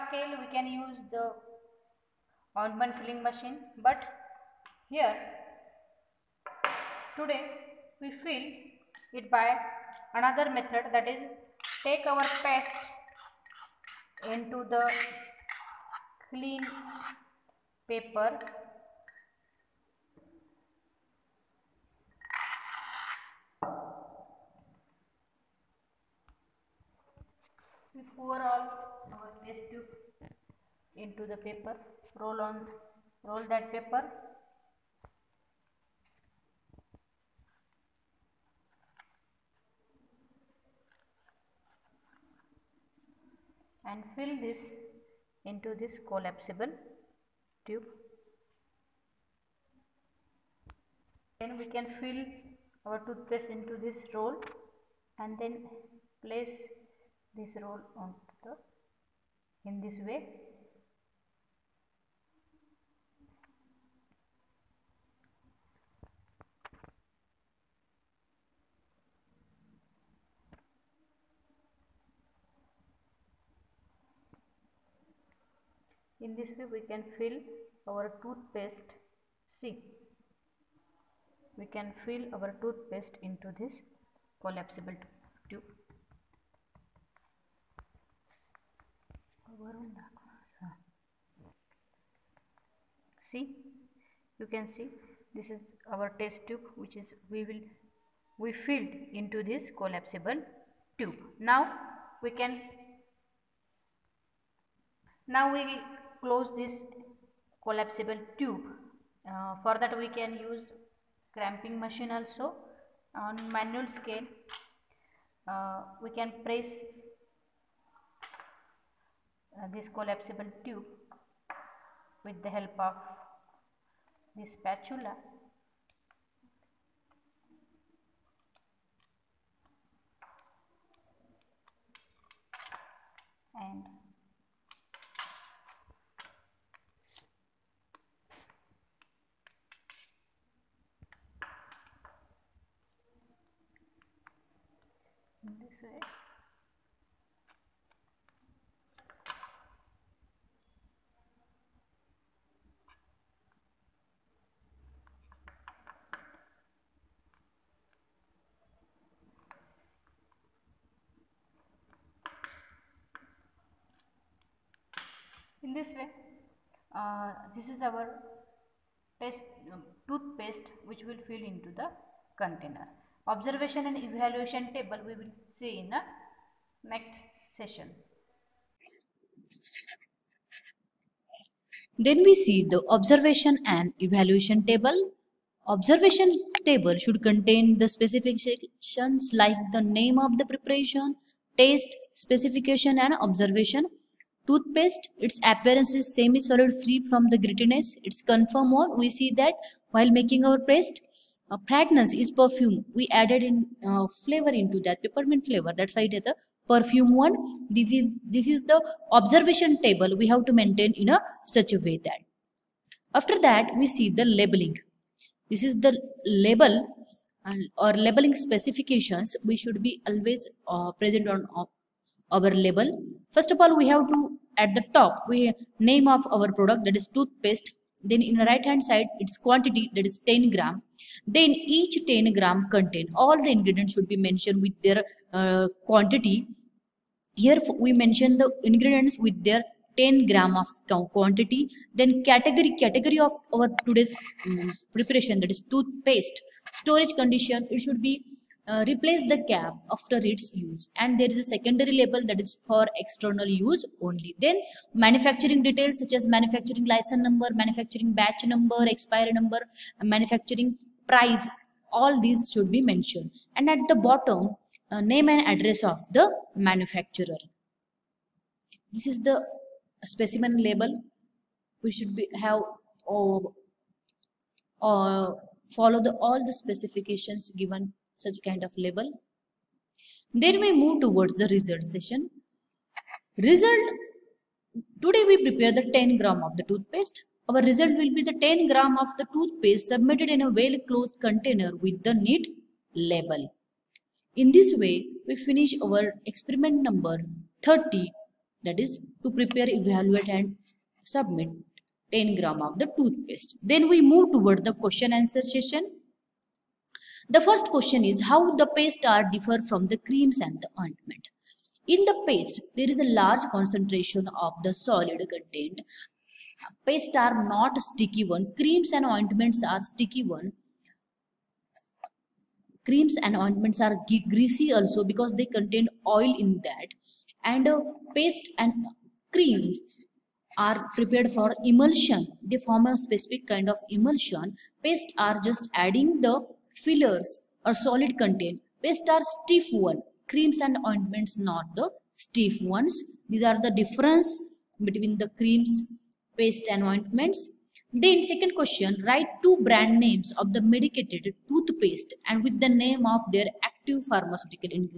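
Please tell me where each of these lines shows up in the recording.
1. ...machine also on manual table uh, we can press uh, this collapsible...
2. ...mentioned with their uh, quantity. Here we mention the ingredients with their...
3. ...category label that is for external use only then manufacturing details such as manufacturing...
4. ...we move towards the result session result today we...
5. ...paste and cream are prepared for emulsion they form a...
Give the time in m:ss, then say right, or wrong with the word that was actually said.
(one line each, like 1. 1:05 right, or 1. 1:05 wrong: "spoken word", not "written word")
1. 1:51 wrong: "scale", not "table"
2. 3:54 right
3. 4:11 wrong: "secondary", not "category"
4. 4:40 right
5. 5:28 right.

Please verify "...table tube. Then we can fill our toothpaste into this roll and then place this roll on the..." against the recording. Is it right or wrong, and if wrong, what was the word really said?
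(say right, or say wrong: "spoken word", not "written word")
wrong: "collapsible", not "table".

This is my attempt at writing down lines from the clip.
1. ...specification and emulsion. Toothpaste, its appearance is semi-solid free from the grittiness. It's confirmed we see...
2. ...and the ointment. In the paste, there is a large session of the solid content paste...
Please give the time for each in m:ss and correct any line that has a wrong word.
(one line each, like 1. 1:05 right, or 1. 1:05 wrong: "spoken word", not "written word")
1. 3:12 wrong: "observation", not "emulsion"
2. 5:10 wrong: "concentration", not "session".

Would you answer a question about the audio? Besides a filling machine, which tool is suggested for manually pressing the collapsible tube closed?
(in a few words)
Spatula.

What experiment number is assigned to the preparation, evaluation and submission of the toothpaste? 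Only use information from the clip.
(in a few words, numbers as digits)
30.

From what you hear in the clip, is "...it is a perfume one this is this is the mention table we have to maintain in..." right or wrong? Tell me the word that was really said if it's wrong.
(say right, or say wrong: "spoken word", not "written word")
wrong: "observation", not "mention".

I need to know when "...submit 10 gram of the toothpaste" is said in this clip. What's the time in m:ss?
5:01.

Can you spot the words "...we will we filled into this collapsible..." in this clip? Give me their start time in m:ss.
1:37.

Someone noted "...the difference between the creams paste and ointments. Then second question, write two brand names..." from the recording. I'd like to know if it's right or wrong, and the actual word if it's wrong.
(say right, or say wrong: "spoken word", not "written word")
right.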